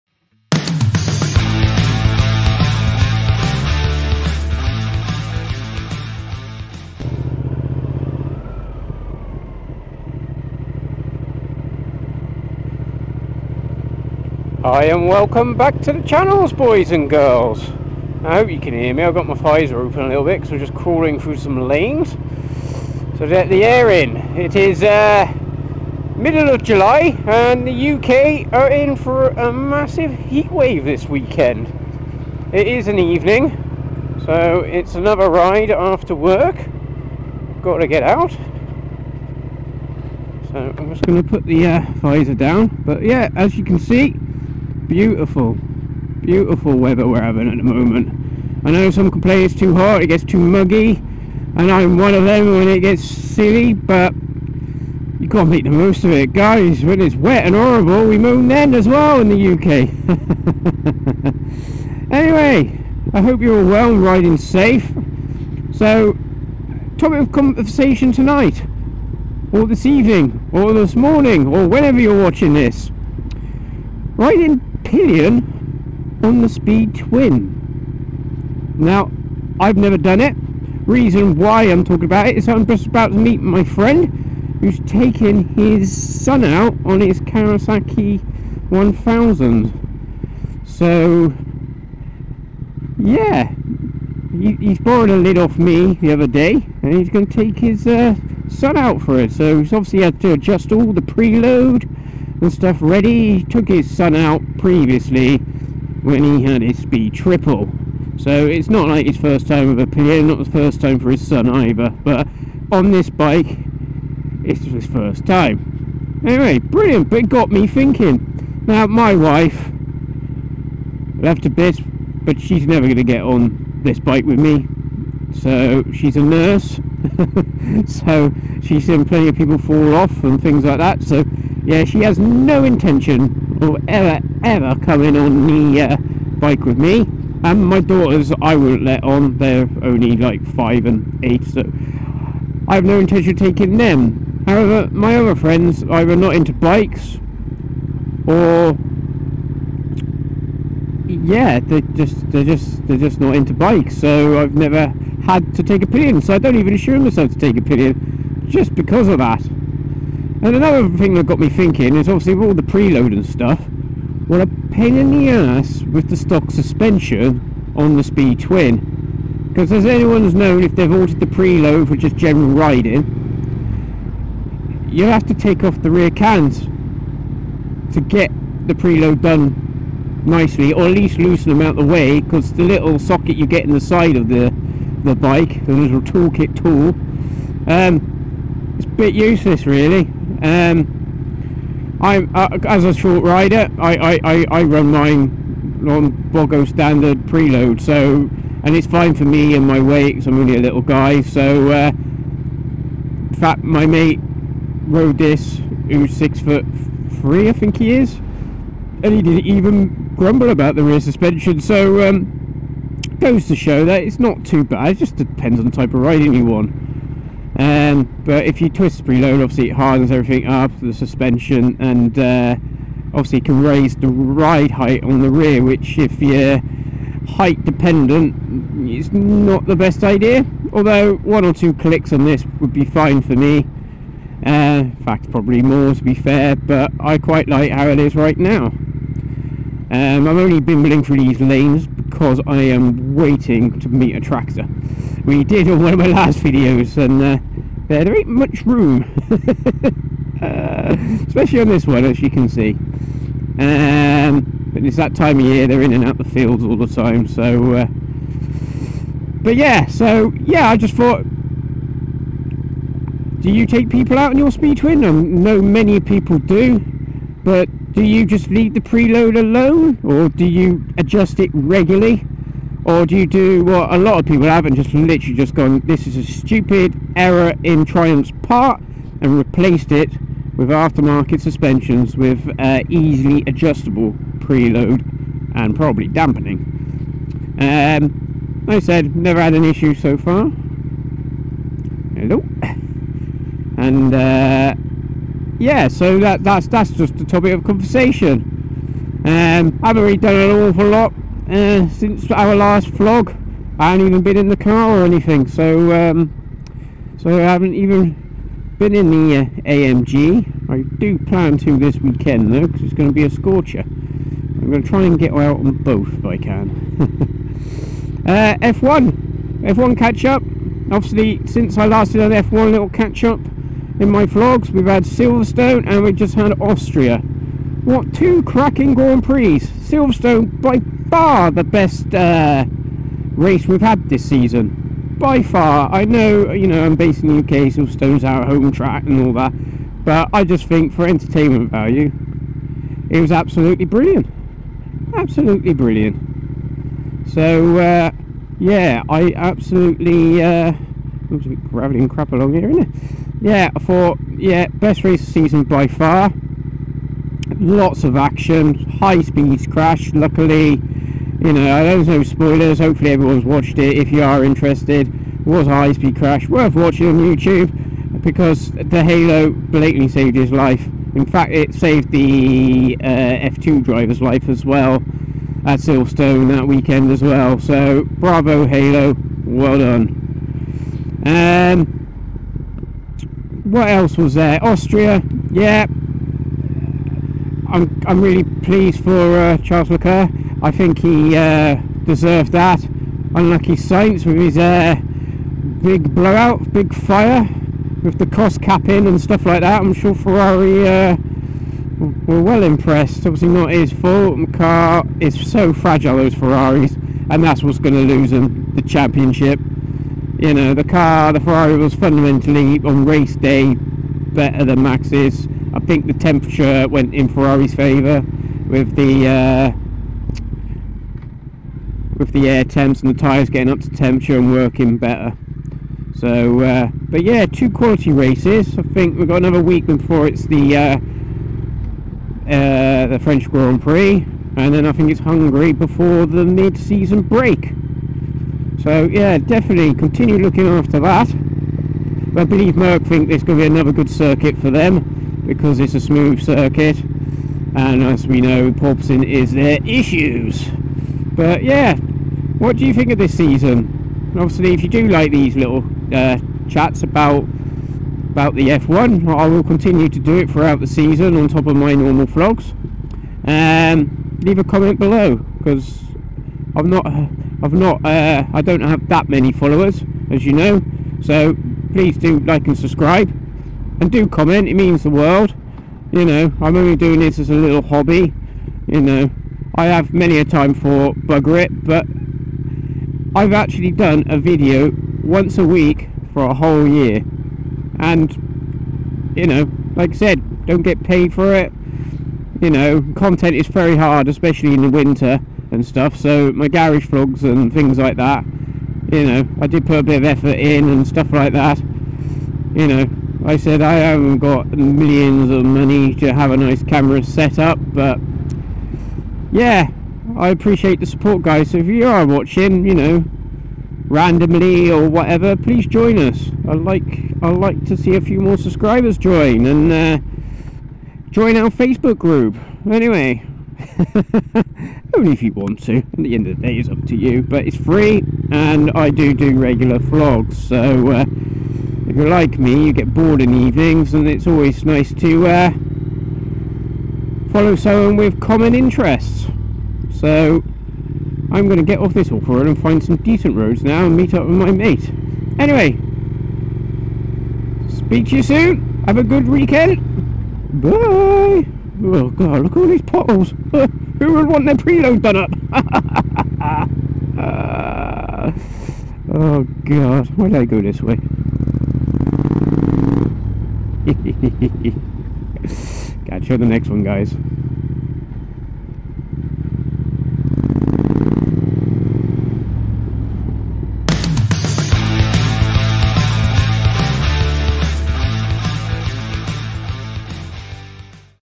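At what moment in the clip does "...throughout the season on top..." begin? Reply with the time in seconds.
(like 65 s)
460 s.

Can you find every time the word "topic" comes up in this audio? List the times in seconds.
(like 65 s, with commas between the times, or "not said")
66 s, 297 s.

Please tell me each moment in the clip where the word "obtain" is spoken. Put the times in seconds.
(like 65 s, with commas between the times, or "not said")
not said.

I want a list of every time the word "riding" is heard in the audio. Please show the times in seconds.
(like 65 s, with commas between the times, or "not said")
64 s, 74 s, 172 s, 216 s.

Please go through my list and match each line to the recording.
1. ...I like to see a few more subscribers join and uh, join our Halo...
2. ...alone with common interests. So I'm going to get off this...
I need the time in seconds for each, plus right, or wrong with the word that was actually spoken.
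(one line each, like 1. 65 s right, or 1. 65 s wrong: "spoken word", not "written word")
1. 517 s wrong: "Facebook", not "Halo"
2. 537 s wrong: "someone", not "alone".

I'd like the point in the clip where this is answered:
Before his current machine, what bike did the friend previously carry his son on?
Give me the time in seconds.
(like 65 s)
106 s.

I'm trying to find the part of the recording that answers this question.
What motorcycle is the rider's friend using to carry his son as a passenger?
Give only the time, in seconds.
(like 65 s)
87 s.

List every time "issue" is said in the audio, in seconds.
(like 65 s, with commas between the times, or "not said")
289 s, 449 s.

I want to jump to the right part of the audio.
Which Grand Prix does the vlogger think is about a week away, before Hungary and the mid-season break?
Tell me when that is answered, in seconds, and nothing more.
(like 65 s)
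433 s.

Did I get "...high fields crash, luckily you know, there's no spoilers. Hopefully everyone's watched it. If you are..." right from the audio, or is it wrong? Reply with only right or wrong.
wrong.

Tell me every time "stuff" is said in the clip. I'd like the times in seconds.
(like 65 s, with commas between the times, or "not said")
102 s, 163 s, 399 s, 495 s, 501 s.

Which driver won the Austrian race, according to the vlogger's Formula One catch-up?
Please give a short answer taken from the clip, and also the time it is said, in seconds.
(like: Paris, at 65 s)
Charles Leclerc, at 389 s.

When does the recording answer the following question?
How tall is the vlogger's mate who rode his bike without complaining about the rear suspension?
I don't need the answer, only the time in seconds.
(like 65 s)
206 s.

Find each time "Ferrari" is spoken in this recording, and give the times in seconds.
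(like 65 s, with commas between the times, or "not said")
400 s, 406 s, 411 s, 417 s.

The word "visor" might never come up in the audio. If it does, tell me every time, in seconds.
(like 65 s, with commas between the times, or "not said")
19 s, 41 s.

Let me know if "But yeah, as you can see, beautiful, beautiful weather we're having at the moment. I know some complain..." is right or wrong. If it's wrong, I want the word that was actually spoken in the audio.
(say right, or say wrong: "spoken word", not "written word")
right.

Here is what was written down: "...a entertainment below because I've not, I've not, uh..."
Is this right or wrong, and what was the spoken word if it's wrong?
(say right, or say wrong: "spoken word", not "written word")
wrong: "comment", not "entertainment".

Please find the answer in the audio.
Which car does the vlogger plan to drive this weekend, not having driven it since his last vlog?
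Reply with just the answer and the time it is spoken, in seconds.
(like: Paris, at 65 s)
AMG, at 309 s.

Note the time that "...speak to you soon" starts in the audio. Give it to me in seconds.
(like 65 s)
547 s.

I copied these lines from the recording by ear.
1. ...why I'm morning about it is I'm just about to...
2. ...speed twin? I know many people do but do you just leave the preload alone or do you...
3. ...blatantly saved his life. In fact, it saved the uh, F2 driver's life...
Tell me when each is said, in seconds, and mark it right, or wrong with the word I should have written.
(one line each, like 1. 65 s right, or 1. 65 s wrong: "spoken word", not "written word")
1. 81 s wrong: "talking", not "morning"
2. 264 s right
3. 369 s right.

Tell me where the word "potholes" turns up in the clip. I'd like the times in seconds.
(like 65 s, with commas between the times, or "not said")
553 s.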